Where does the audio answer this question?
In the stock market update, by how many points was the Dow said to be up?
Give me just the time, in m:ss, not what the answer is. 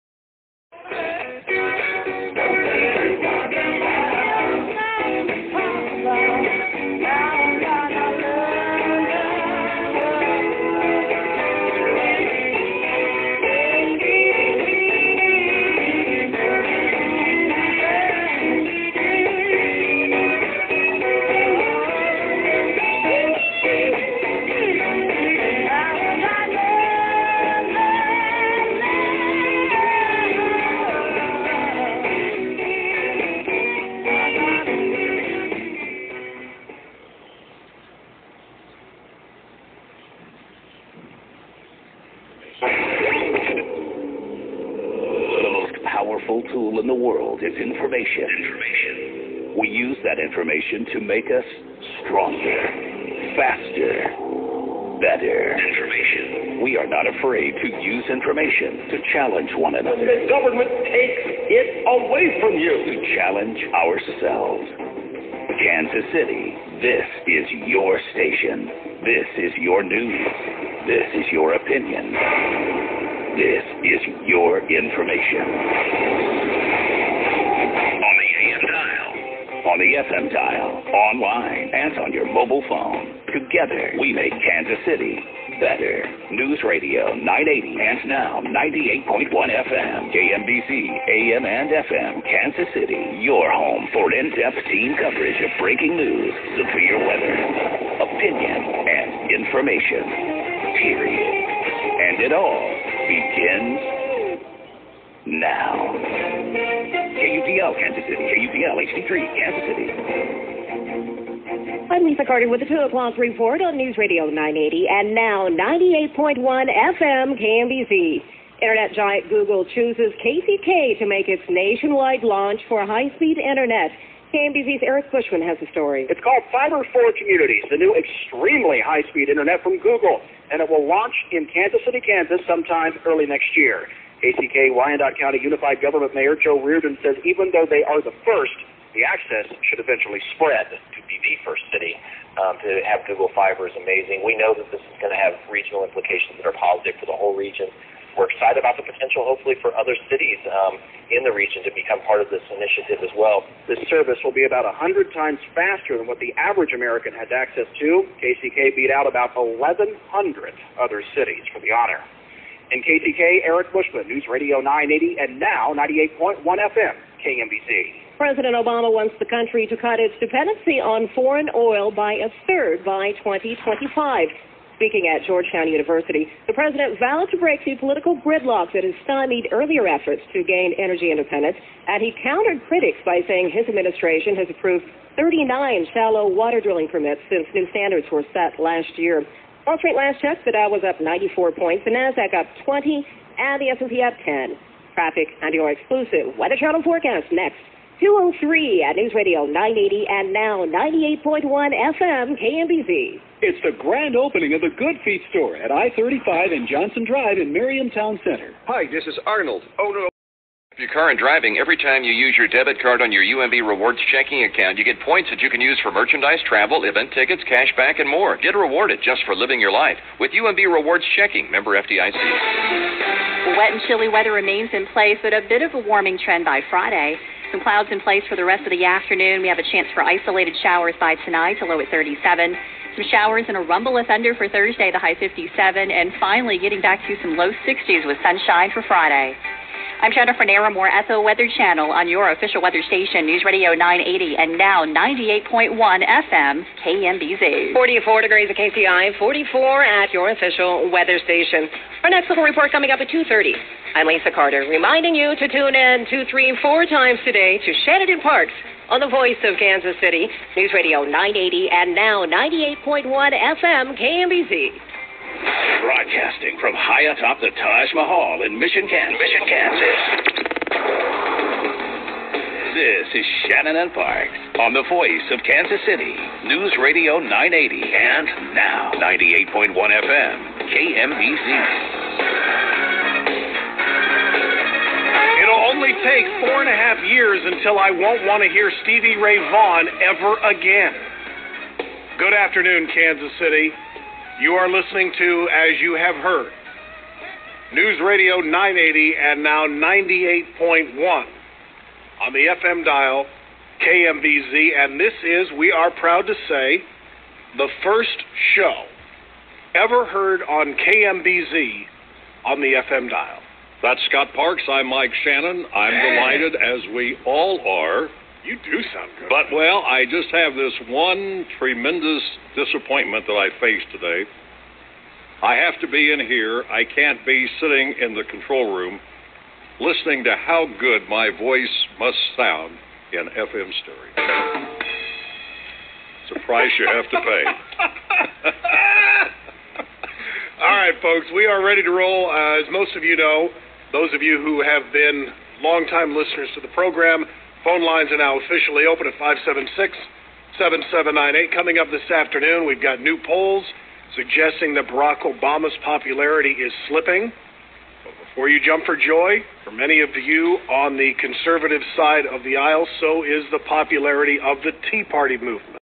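3:10.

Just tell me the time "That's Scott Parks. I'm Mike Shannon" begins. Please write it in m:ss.
5:13.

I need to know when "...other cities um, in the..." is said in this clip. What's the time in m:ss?
2:29.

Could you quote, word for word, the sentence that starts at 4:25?
Broadcasting from high atop the Taj Mahal in Mission, Kansas.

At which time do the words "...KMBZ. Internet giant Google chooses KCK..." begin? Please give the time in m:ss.
1:57.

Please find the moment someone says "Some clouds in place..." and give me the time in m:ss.
3:47.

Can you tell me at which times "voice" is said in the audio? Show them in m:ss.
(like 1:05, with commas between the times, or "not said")
4:19, 4:34, 5:31.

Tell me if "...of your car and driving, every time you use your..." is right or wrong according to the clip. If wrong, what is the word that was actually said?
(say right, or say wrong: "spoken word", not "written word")
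right.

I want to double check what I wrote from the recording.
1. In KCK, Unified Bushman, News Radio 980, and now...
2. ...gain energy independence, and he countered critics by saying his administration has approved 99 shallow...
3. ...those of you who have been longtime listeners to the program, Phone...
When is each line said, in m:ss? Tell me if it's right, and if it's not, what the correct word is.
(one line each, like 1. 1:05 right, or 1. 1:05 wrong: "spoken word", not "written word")
1. 2:42 wrong: "Eric", not "Unified"
2. 3:00 wrong: "39", not "99"
3. 5:43 right.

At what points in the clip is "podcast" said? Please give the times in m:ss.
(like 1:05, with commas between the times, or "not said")
not said.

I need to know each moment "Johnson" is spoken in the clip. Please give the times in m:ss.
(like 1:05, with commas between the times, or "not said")
3:26.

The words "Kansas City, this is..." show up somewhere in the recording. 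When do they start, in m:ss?
1:05.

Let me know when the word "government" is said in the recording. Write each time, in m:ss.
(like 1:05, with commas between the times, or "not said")
1:00, 2:15.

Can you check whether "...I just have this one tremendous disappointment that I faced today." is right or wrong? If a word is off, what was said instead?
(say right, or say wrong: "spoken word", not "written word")
right.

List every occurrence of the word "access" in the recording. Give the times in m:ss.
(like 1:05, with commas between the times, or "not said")
2:19, 2:37.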